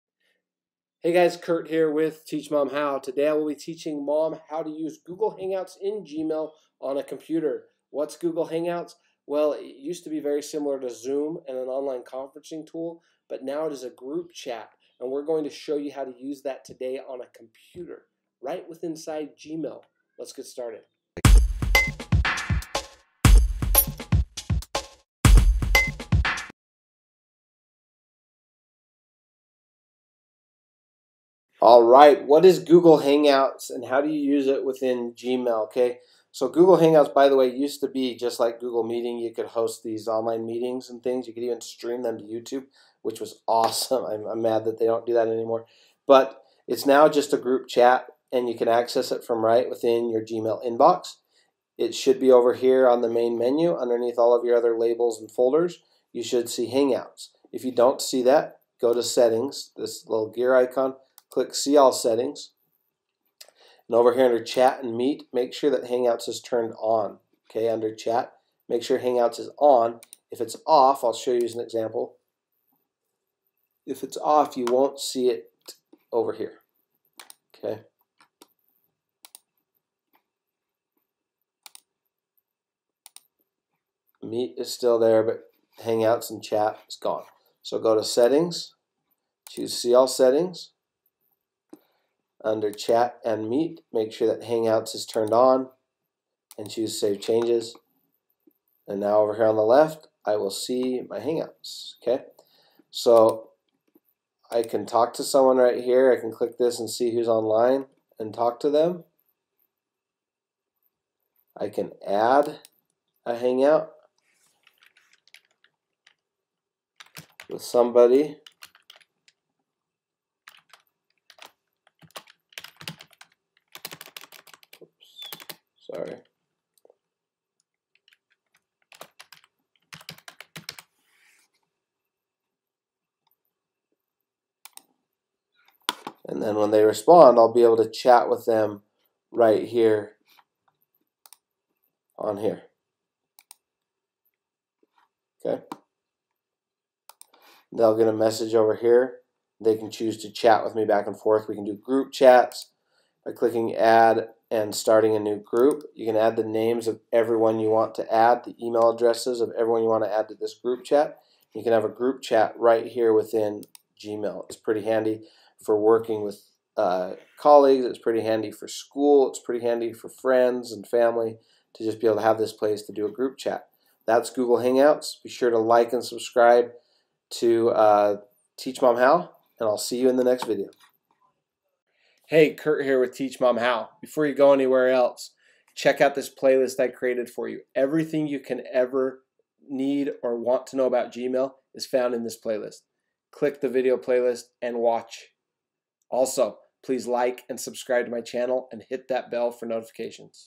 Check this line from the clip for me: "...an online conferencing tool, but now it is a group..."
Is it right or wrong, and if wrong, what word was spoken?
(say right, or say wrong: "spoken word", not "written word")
right.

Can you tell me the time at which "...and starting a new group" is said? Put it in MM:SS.
02:34.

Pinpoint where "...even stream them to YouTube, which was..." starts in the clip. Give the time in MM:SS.
00:41.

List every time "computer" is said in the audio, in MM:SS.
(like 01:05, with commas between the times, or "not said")
00:07, 00:17.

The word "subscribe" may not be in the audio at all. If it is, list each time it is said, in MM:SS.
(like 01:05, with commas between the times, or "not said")
02:56, 03:17.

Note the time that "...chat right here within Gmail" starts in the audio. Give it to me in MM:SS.
02:42.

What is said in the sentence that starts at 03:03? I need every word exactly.
Before you go anywhere else, check out this playlist I created for you.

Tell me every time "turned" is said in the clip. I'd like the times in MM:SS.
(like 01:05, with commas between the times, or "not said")
01:06, 01:35.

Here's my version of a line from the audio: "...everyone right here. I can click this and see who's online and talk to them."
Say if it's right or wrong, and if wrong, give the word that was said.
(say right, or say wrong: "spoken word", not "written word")
wrong: "someone", not "everyone".